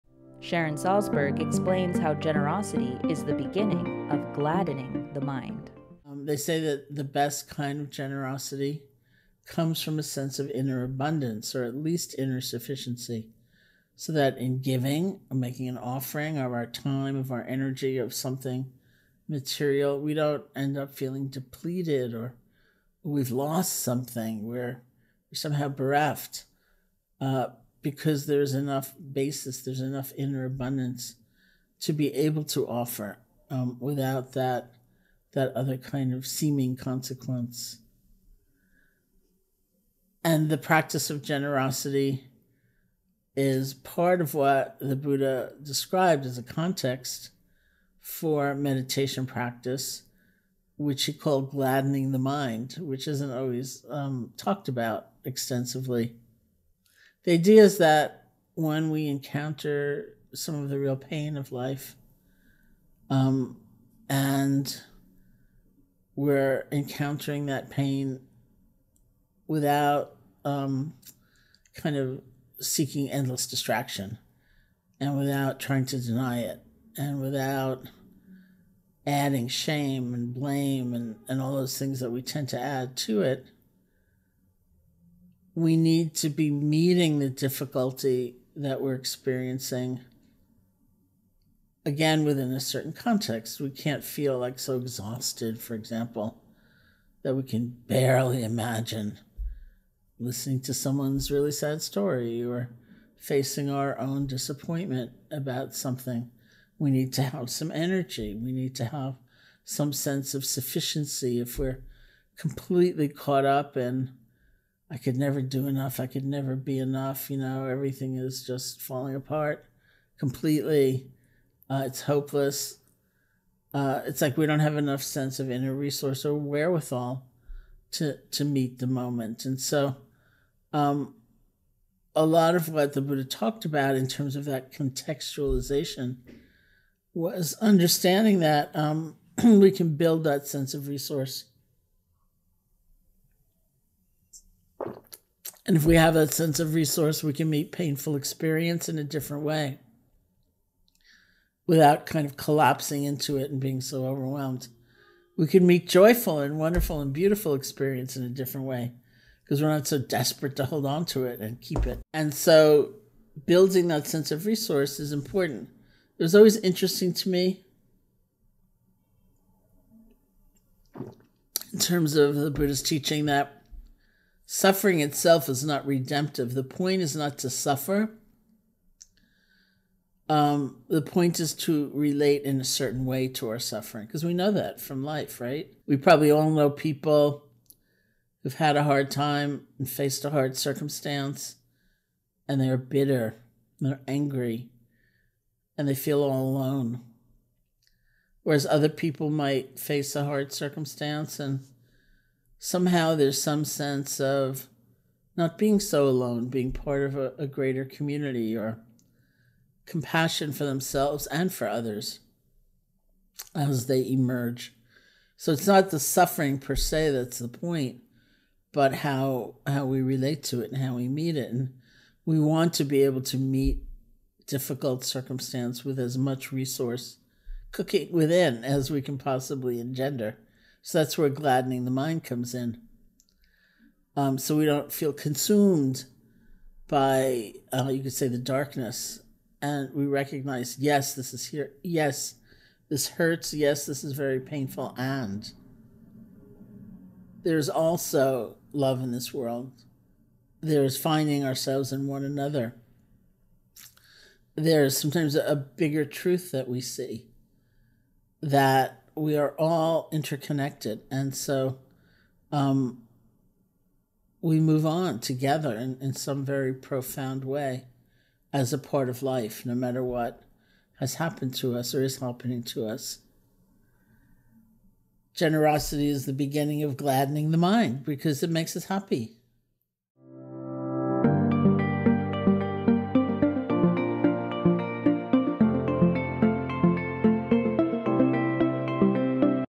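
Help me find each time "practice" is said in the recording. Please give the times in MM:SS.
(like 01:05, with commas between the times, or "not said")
00:40, 00:49.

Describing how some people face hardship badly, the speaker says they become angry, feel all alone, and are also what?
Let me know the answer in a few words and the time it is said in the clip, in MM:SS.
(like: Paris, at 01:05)
bitter, at 03:12.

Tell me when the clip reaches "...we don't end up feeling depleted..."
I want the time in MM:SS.
00:20.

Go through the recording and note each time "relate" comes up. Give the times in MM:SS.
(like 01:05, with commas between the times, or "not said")
03:01, 03:40.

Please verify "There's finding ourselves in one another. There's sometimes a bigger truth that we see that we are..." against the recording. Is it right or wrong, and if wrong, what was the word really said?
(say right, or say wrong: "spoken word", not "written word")
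right.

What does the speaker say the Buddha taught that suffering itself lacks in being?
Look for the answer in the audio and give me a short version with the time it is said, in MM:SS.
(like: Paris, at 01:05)
redemptive, at 02:55.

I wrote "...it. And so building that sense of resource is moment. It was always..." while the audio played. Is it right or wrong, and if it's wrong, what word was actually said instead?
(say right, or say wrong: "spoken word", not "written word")
wrong: "important", not "moment".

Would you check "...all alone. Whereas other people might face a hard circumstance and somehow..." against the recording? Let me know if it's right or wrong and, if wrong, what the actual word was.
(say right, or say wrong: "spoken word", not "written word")
right.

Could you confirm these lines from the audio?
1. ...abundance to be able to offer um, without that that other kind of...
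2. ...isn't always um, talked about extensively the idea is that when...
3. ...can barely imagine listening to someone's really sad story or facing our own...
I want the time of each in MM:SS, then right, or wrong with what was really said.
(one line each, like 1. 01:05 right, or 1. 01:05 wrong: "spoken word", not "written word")
1. 00:30 right
2. 00:53 right
3. 01:37 right.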